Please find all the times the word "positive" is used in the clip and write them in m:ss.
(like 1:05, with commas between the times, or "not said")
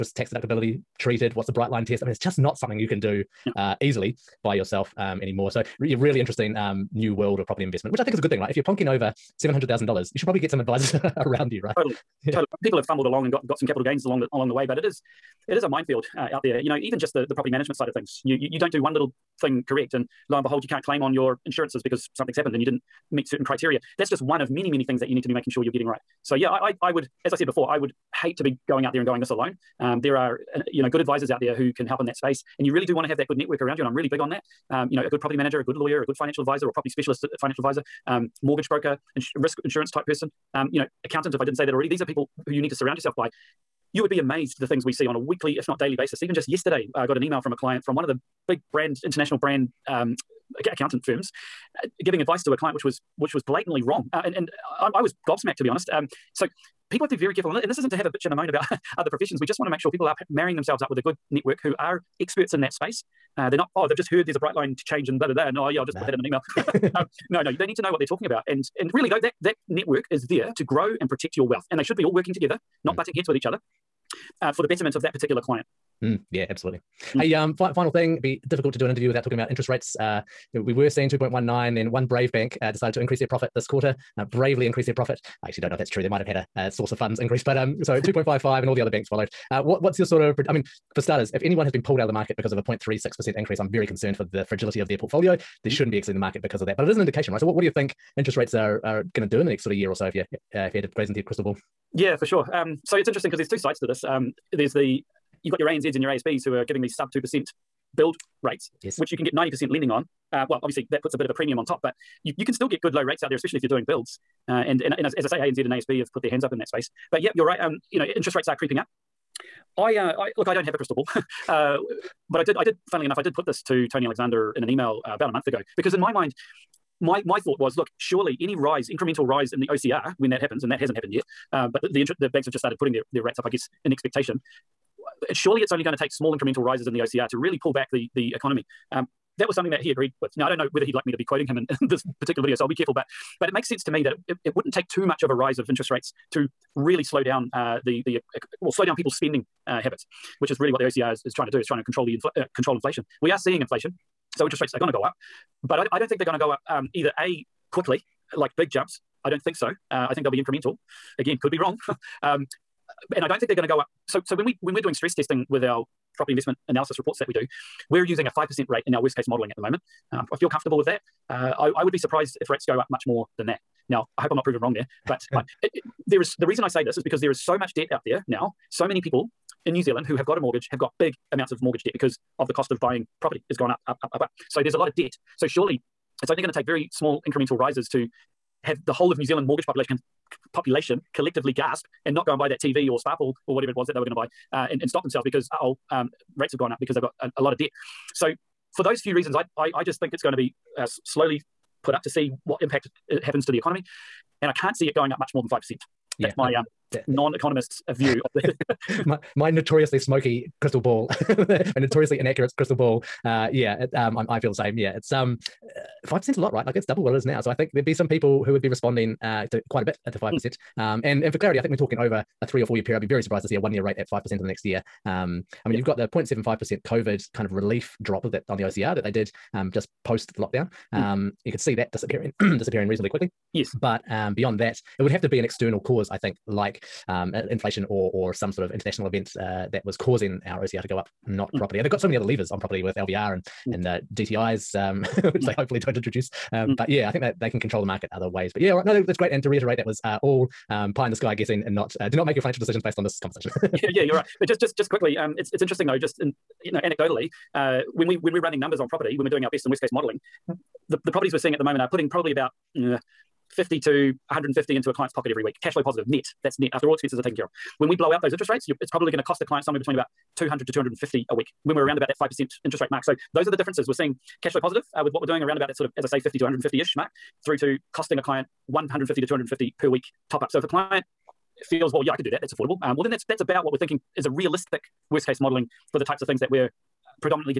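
4:25, 4:34.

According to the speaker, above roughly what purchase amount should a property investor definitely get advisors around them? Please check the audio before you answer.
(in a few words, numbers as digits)
$700,000.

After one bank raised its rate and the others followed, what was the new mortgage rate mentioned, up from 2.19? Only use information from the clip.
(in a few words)
2.55.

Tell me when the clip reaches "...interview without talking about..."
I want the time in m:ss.
1:18.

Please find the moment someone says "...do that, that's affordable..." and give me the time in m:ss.
4:42.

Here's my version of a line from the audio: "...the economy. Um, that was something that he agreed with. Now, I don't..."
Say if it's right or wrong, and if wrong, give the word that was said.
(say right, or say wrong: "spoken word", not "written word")
right.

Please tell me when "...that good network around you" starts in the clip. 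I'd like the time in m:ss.
0:33.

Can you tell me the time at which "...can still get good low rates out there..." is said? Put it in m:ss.
1:52.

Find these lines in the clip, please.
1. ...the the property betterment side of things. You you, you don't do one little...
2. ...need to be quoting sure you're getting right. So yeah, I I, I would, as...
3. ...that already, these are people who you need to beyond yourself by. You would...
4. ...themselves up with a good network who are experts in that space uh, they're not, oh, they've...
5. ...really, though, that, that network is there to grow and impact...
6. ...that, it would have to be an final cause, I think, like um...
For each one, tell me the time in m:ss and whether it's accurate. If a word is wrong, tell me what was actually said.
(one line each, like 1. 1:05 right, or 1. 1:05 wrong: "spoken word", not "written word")
1. 0:17 wrong: "management", not "betterment"
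2. 0:25 wrong: "making", not "quoting"
3. 0:41 wrong: "surround", not "beyond"
4. 1:00 right
5. 1:08 wrong: "protect", not "impact"
6. 3:54 wrong: "external", not "final".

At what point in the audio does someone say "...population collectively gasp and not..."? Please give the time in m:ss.
3:10.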